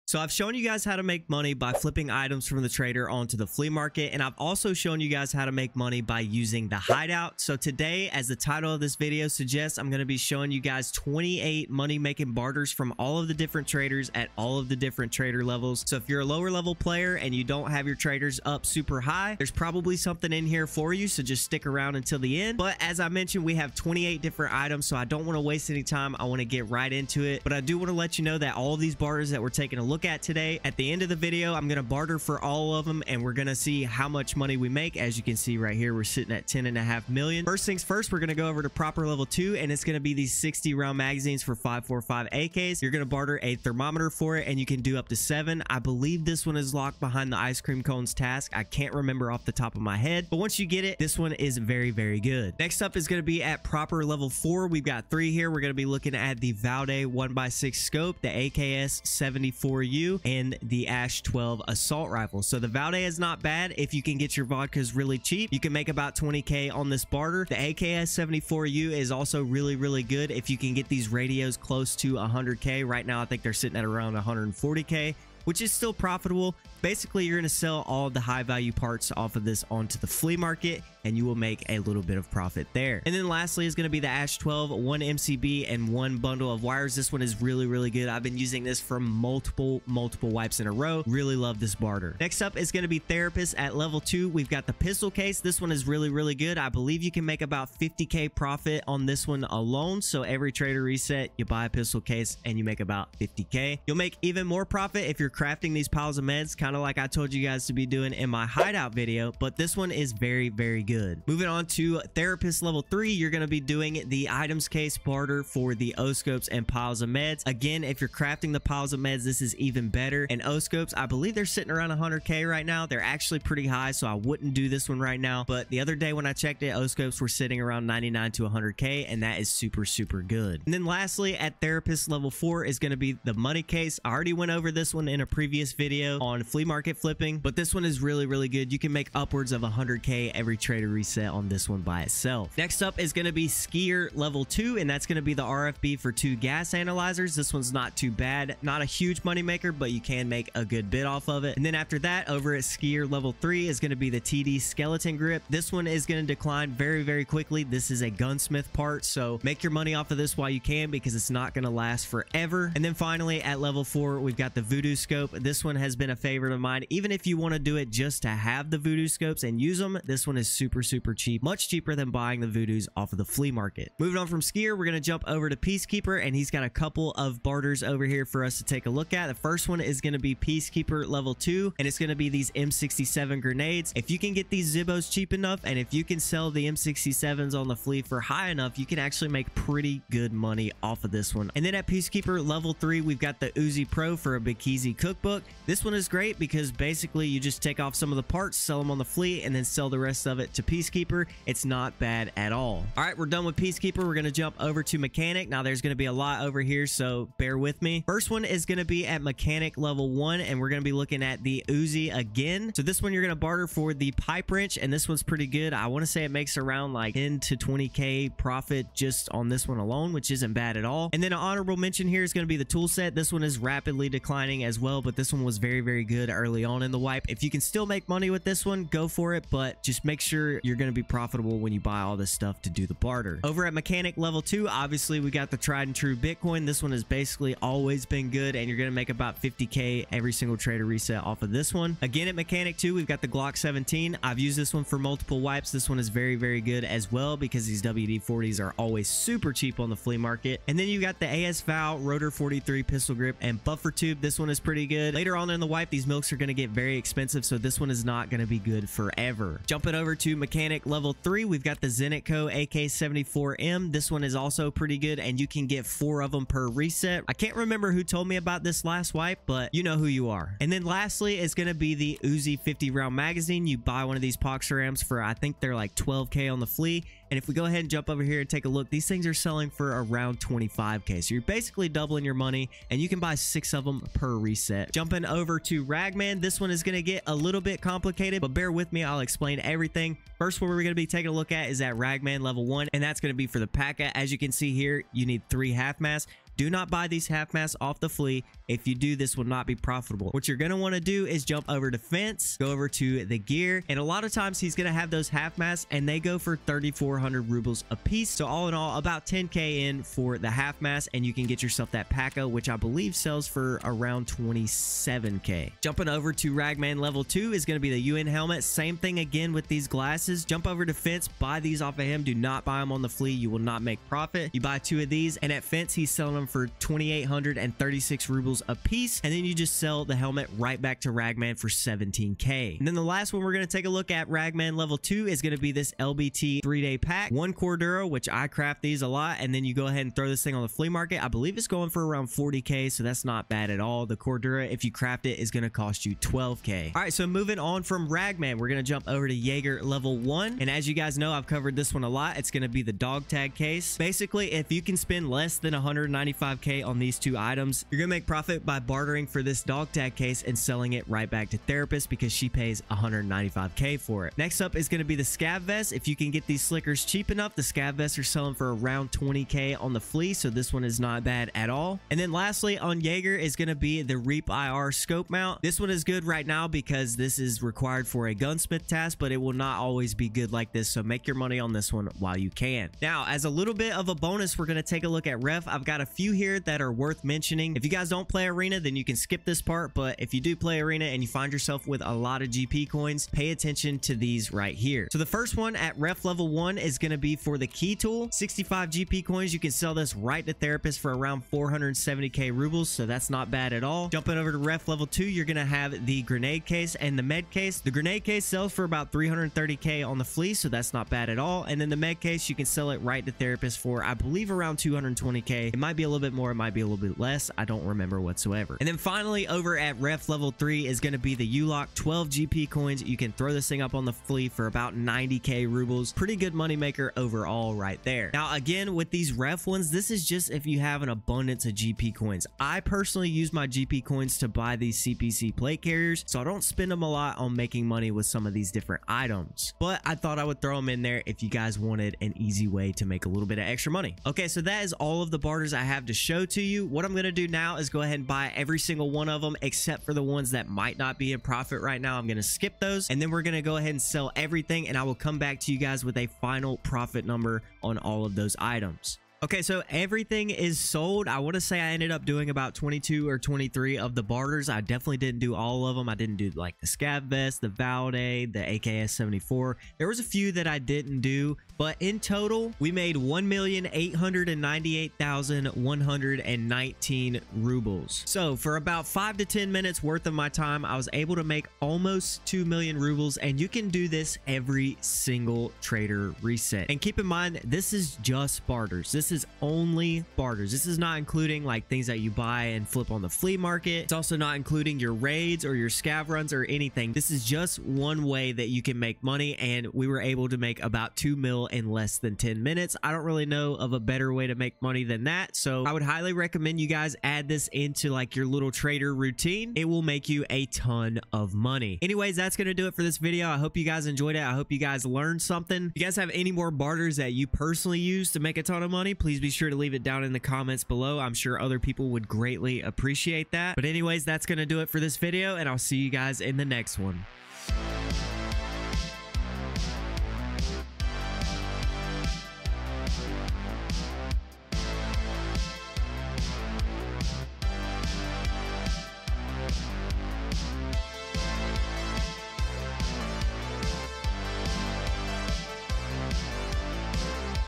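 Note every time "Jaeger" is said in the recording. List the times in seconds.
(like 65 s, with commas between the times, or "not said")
349 s, 373 s.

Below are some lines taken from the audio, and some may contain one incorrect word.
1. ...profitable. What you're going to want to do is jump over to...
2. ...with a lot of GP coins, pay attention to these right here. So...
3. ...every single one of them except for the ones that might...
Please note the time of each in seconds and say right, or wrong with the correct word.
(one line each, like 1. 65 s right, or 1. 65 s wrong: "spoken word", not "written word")
1. 299 s right
2. 391 s right
3. 448 s right.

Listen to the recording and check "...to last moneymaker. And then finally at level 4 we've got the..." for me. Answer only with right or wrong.
wrong.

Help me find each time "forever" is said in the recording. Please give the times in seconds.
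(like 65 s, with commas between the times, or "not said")
162 s, 258 s.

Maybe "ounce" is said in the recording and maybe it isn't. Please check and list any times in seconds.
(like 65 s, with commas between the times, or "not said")
not said.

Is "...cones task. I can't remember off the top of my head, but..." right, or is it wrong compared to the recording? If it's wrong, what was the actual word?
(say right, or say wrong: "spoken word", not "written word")
right.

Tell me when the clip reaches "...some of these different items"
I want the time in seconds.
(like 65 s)
438 s.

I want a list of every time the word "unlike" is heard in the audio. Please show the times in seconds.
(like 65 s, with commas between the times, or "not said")
not said.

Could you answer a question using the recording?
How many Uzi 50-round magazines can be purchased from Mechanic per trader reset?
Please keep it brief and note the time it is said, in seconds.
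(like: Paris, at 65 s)
6, at 283 s.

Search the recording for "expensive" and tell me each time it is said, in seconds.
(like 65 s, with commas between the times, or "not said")
256 s.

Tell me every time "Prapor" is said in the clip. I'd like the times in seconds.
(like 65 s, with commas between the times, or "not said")
38 s, 53 s.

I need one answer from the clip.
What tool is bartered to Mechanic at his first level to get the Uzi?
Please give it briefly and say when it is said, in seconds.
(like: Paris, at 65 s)
Pipe wrench, at 214 s.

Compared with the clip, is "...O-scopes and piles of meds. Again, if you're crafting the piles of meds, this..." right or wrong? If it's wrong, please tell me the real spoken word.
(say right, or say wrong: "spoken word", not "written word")
right.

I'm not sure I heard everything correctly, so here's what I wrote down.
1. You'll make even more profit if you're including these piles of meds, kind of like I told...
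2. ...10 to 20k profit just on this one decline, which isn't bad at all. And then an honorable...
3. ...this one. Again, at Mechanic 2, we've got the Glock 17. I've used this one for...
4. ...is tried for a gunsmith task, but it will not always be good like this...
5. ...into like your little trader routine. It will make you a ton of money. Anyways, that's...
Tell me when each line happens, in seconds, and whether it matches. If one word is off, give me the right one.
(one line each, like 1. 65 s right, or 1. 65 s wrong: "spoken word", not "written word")
1. 103 s wrong: "crafting", not "including"
2. 217 s wrong: "alone", not "decline"
3. 241 s right
4. 377 s wrong: "required", not "tried"
5. 507 s right.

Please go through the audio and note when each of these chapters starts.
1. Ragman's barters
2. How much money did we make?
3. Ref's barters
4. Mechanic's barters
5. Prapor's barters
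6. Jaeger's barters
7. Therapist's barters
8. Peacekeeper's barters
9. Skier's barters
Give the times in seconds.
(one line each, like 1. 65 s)
1. 284 s
2. 459 s
3. 385 s
4. 205 s
5. 37 s
6. 349 s
7. 92 s
8. 173 s
9. 142 s.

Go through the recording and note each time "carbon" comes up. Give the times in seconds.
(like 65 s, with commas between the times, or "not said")
not said.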